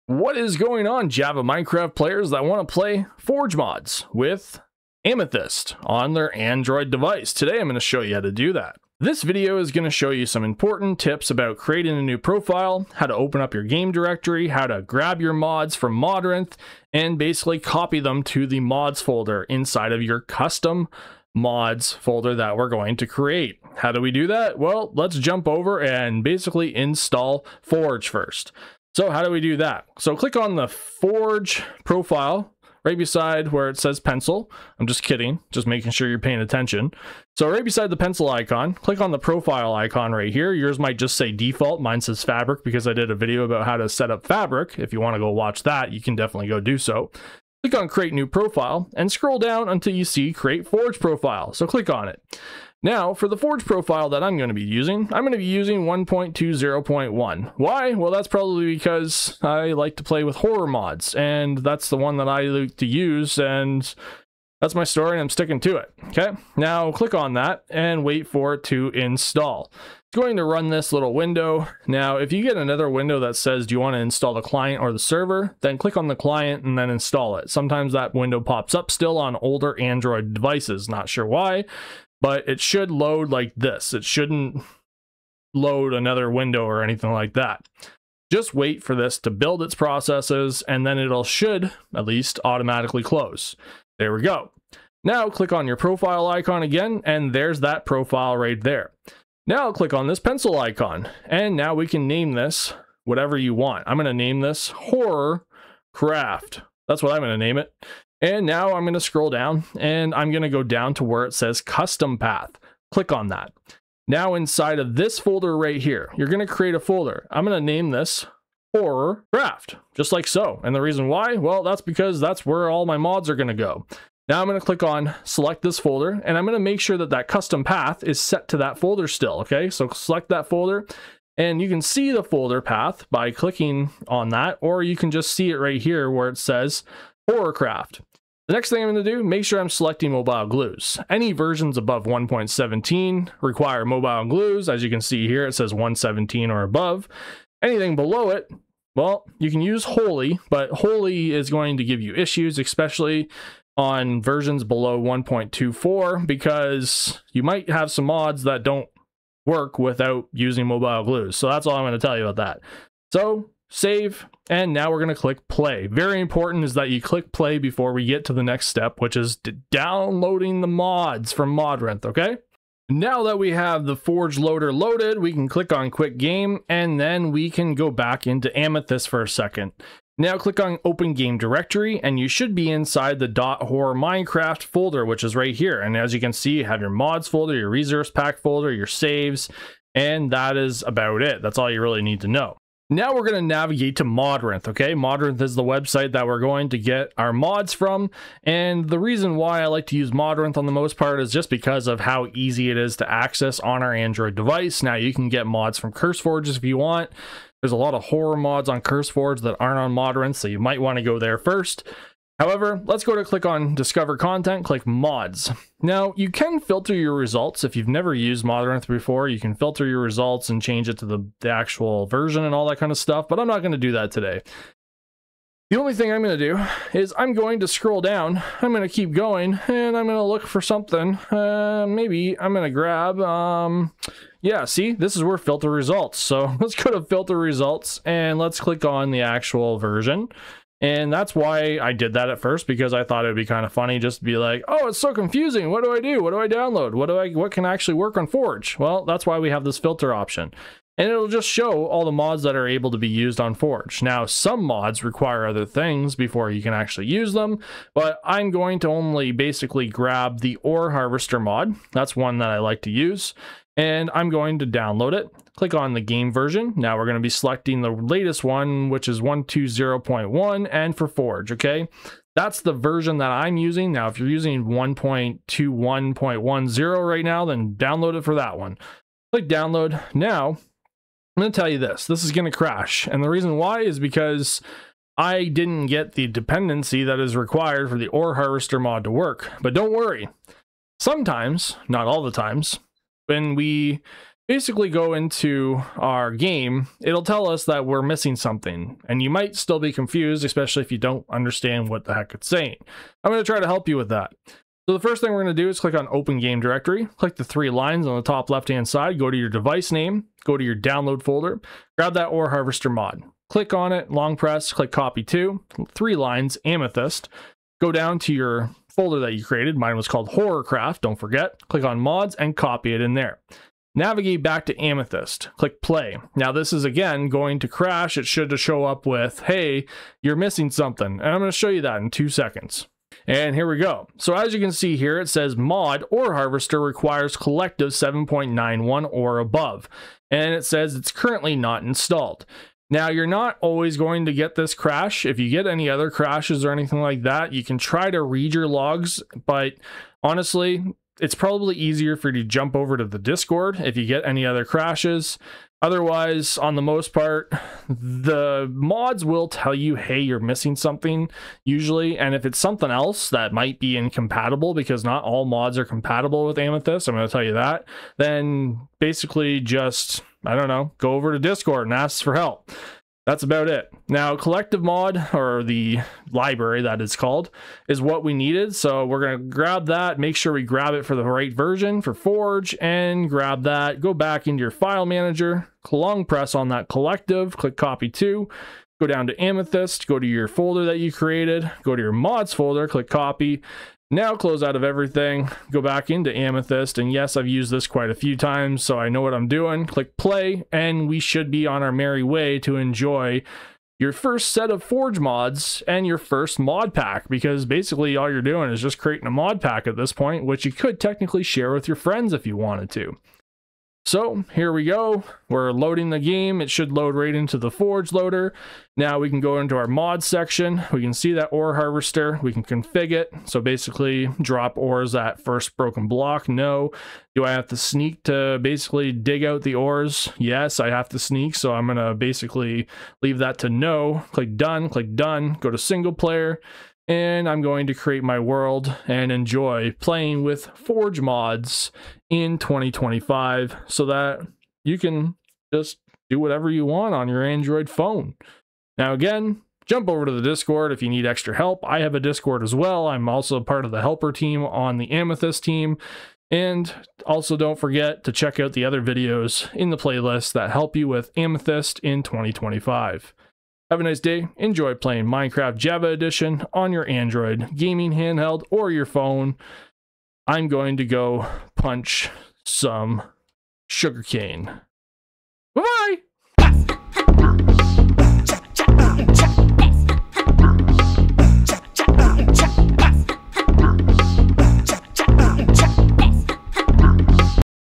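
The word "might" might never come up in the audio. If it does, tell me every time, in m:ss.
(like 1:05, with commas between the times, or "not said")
0:40, 2:37, 3:30, 4:59, 6:03.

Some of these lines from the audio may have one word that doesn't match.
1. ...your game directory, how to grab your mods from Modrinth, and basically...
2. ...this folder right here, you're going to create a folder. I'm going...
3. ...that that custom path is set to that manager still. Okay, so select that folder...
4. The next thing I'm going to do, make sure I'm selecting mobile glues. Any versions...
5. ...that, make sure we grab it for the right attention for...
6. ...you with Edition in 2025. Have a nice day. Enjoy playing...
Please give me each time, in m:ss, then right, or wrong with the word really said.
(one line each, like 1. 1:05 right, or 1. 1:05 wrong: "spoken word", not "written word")
1. 0:13 right
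2. 1:54 right
3. 2:06 wrong: "folder", not "manager"
4. 2:18 right
5. 6:19 wrong: "version", not "attention"
6. 7:40 wrong: "Amethyst", not "Edition".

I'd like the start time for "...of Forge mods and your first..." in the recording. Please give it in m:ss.
6:44.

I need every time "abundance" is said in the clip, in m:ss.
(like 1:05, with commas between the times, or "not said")
not said.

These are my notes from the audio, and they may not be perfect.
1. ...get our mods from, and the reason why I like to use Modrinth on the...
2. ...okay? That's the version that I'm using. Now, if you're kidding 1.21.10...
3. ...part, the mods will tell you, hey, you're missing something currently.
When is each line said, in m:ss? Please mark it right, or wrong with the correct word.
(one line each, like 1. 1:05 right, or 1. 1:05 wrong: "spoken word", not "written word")
1. 3:16 right
2. 4:31 wrong: "using", not "kidding"
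3. 5:57 wrong: "usually", not "currently".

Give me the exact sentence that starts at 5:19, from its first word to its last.
Mine was called Horrorcraft, don't forget.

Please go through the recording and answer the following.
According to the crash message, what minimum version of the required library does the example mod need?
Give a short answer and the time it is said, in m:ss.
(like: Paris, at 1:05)
7.91, at 5:37.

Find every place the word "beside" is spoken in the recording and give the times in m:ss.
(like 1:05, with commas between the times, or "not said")
0:32, 0:37.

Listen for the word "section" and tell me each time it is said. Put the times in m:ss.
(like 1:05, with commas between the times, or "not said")
7:00.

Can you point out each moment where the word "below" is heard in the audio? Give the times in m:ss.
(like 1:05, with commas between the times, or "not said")
2:27, 2:34.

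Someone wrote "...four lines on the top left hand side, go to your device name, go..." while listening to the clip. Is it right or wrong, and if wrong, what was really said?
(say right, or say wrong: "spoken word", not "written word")
wrong: "three", not "four".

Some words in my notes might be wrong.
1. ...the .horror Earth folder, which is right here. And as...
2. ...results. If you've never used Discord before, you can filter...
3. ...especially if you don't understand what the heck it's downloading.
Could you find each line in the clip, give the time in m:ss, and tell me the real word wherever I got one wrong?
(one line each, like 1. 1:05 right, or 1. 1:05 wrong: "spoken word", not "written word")
1. 3:03 wrong: "Minecraft", not "Earth"
2. 3:37 wrong: "Earth", not "Discord"
3. 5:00 wrong: "saying", not "downloading".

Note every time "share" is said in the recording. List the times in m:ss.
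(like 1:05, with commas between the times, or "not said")
6:51.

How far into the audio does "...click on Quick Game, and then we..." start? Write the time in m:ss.
2:55.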